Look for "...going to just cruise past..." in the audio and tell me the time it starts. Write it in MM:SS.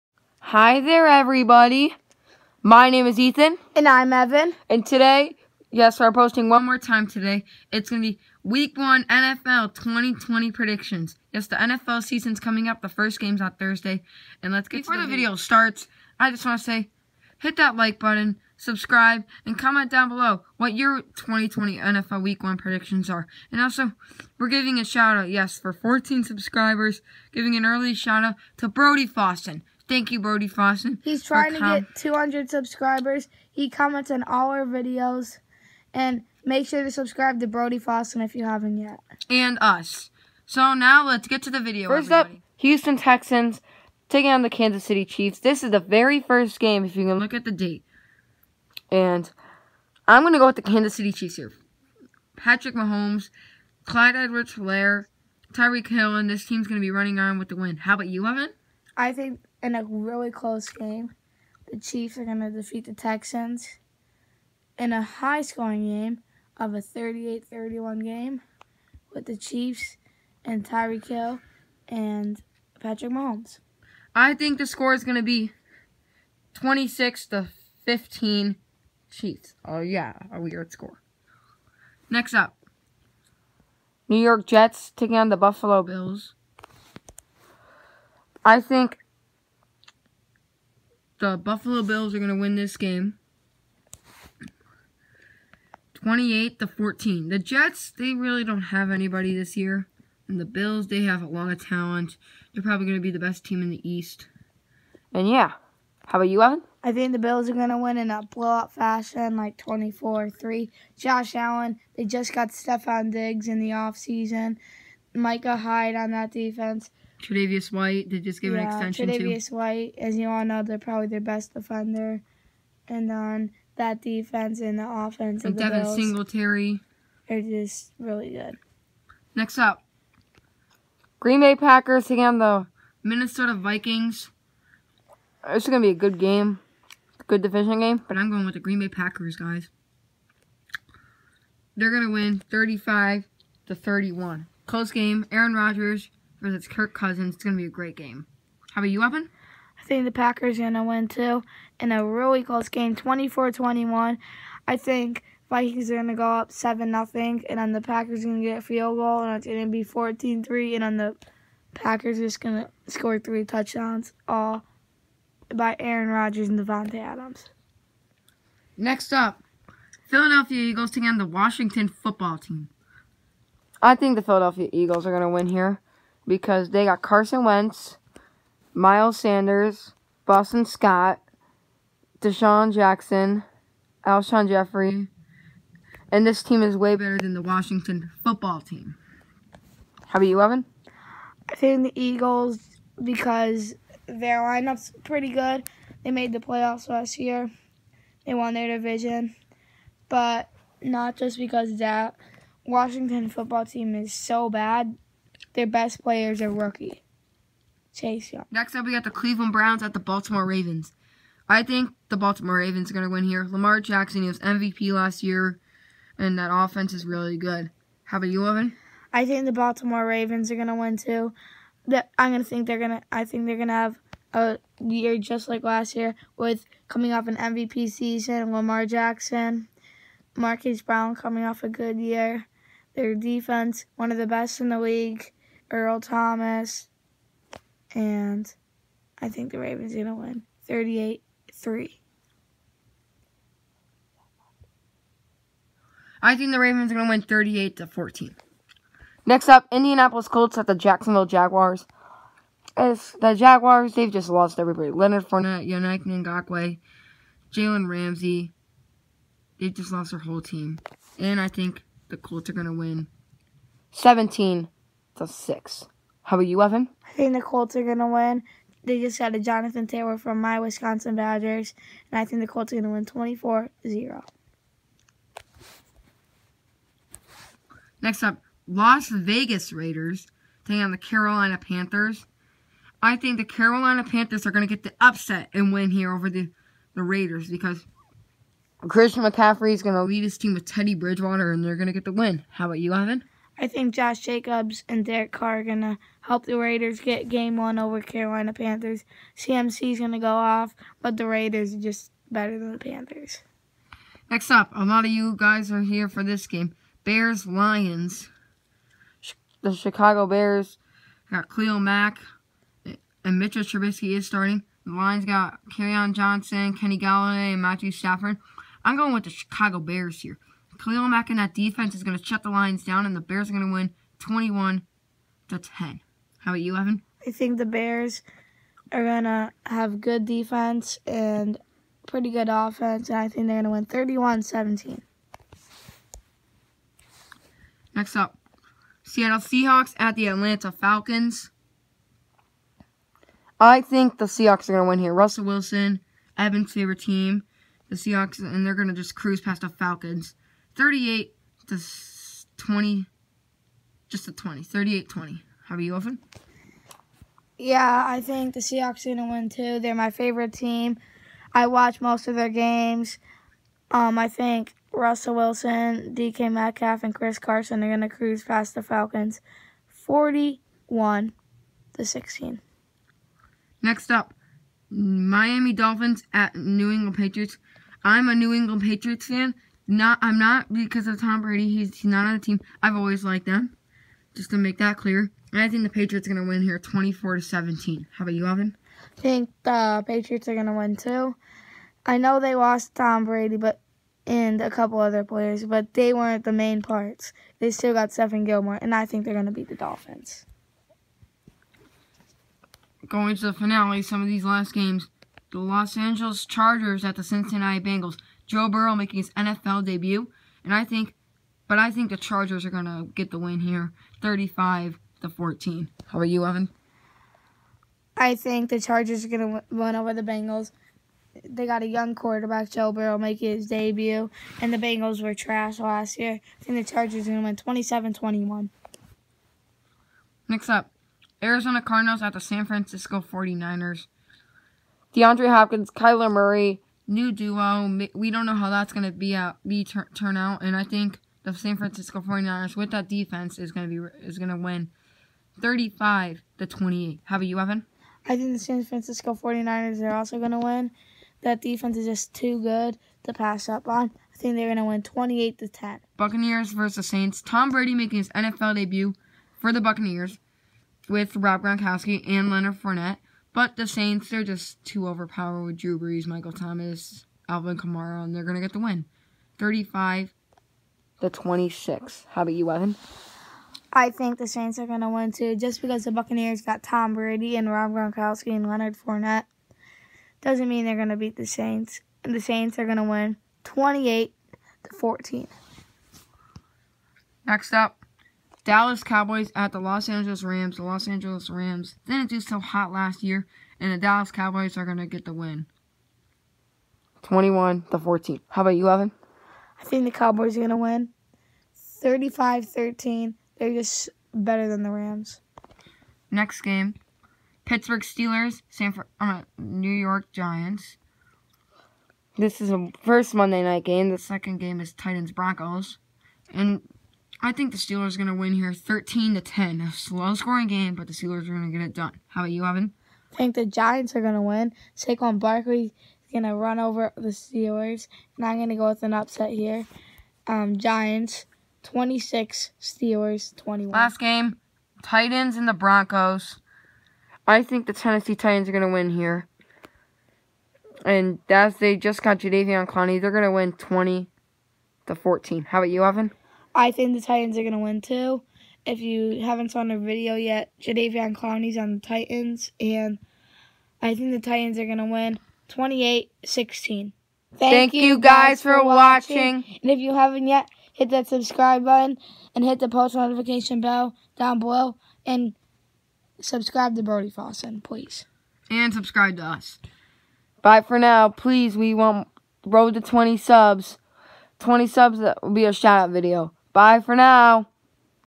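05:48.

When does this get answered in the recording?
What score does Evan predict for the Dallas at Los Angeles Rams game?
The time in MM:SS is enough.
08:21.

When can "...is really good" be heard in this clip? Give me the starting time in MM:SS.
03:36.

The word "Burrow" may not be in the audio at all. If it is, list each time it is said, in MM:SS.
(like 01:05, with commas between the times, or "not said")
06:48, 07:02.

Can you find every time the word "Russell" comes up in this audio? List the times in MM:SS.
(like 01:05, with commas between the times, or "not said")
05:45, 06:04.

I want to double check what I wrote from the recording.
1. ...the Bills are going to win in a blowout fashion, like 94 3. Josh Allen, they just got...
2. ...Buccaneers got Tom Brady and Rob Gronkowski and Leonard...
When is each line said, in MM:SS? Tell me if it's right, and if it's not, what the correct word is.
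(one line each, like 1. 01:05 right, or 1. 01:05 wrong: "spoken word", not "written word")
1. 01:47 wrong: "24", not "94"
2. 07:56 right.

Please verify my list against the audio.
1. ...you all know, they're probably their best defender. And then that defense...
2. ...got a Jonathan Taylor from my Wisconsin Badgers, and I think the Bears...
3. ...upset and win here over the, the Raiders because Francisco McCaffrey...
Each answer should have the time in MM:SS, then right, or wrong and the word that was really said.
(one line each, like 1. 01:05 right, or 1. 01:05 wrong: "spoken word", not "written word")
1. 02:00 right
2. 04:29 wrong: "Colts", not "Bears"
3. 04:44 wrong: "Christian", not "Francisco".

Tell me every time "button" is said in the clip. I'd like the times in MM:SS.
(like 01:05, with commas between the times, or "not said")
00:17, 09:21.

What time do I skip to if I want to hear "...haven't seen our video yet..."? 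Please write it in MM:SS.
09:09.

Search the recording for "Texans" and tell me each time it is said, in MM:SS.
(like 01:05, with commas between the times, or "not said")
00:42, 01:02.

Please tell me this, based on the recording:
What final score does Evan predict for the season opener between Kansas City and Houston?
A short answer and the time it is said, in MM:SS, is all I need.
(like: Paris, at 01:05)
38-31, at 01:06.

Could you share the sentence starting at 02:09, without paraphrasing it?
Next up, Green Bay Packers taking on the Minnesota Vikings.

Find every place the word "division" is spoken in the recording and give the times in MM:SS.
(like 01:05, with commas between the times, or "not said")
02:17, 03:18.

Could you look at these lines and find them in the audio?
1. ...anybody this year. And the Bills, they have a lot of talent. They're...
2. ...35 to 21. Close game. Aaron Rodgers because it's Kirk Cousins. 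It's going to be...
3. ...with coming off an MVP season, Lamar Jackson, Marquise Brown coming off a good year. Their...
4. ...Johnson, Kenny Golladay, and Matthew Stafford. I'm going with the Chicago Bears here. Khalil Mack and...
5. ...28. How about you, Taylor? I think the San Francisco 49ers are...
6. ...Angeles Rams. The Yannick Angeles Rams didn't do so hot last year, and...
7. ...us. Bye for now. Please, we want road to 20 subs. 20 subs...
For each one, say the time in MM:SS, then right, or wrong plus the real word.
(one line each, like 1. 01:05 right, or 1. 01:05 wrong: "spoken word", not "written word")
1. 01:38 right
2. 02:22 wrong: "31", not "21"
3. 03:46 right
4. 05:16 right
5. 07:26 wrong: "Evan", not "Taylor"
6. 08:10 wrong: "Los", not "Yannick"
7. 09:29 right.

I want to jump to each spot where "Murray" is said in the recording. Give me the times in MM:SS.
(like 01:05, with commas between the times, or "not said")
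07:16.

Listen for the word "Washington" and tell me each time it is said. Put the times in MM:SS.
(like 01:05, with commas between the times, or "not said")
02:51, 03:07, 03:22.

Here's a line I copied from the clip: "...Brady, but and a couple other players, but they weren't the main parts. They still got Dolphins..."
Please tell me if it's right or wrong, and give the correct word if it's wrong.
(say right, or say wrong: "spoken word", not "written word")
wrong: "Stephon", not "Dolphins".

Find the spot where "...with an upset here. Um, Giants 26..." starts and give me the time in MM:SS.
08:48.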